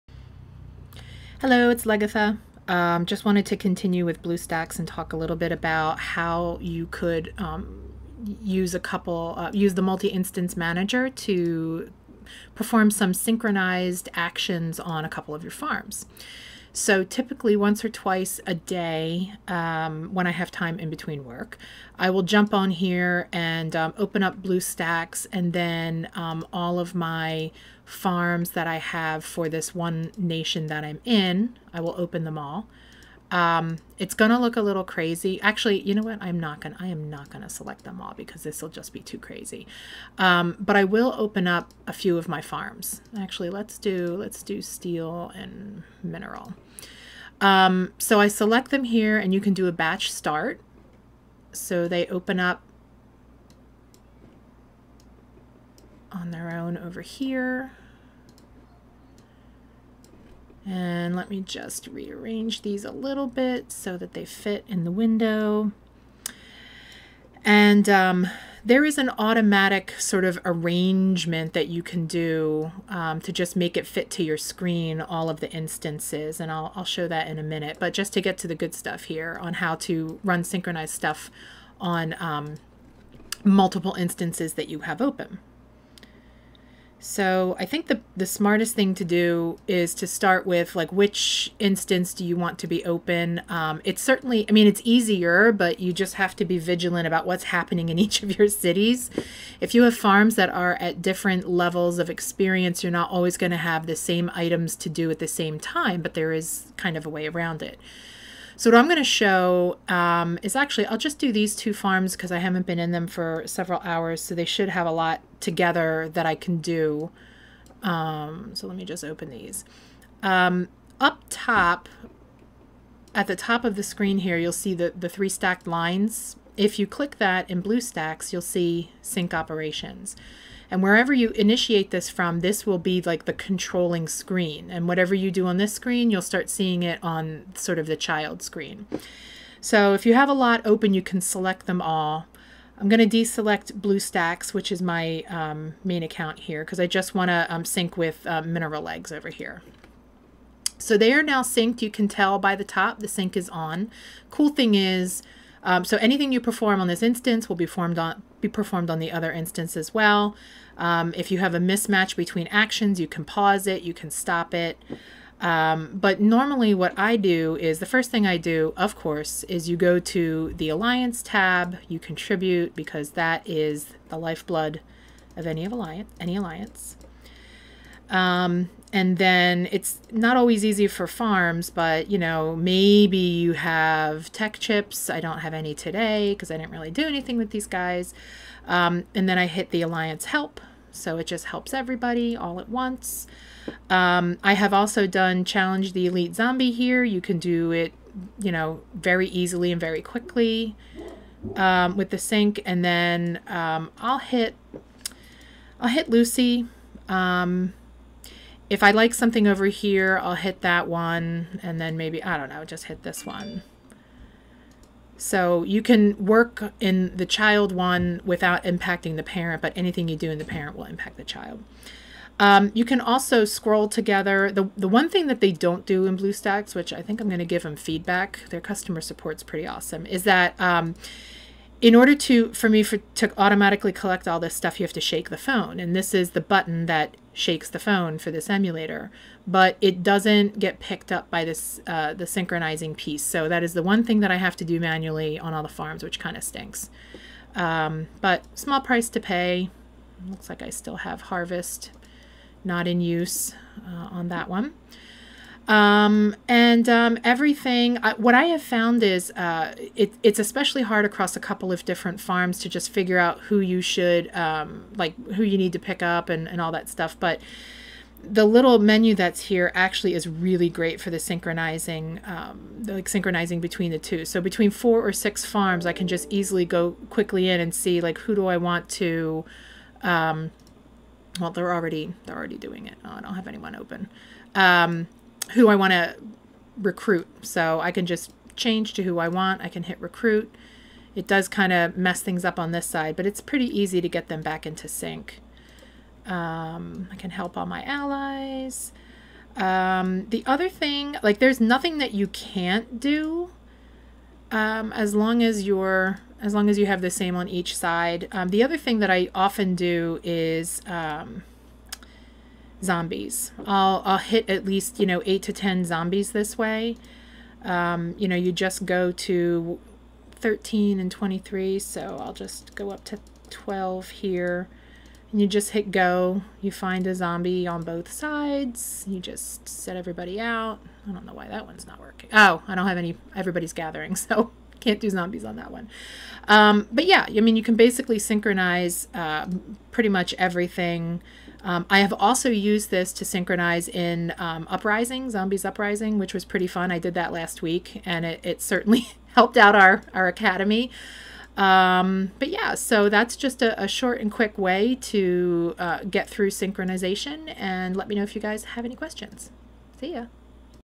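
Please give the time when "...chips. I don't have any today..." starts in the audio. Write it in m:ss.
3:04.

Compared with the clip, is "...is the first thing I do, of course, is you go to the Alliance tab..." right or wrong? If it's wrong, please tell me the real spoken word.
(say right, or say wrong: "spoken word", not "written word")
right.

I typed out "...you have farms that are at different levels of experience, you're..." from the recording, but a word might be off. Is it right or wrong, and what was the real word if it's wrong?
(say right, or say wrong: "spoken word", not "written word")
right.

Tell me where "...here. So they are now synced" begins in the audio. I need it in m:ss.
2:29.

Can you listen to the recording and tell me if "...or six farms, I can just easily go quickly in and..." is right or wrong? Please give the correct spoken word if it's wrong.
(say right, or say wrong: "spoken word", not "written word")
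right.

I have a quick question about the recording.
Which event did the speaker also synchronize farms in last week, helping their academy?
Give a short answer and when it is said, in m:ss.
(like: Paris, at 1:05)
Zombies Uprising, at 5:45.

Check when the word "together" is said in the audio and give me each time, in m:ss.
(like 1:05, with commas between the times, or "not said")
1:55, 3:43.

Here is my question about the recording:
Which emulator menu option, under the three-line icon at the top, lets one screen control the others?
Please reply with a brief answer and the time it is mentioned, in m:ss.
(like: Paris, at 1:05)
Sync operations, at 2:09.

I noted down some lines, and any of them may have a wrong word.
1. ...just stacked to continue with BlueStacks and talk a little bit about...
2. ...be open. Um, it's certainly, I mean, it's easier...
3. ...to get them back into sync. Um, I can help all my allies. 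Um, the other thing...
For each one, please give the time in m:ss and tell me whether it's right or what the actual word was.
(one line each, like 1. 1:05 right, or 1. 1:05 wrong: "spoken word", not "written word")
1. 0:03 wrong: "wanted", not "stacked"
2. 1:32 right
3. 4:53 right.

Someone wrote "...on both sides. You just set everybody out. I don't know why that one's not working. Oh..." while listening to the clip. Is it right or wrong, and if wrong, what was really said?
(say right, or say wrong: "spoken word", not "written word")
right.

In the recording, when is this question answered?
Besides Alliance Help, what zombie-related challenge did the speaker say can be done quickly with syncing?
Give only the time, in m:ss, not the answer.
3:15.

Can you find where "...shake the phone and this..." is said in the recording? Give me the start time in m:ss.
3:55.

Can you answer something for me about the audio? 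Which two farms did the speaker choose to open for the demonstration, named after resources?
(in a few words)
Steel and mineral.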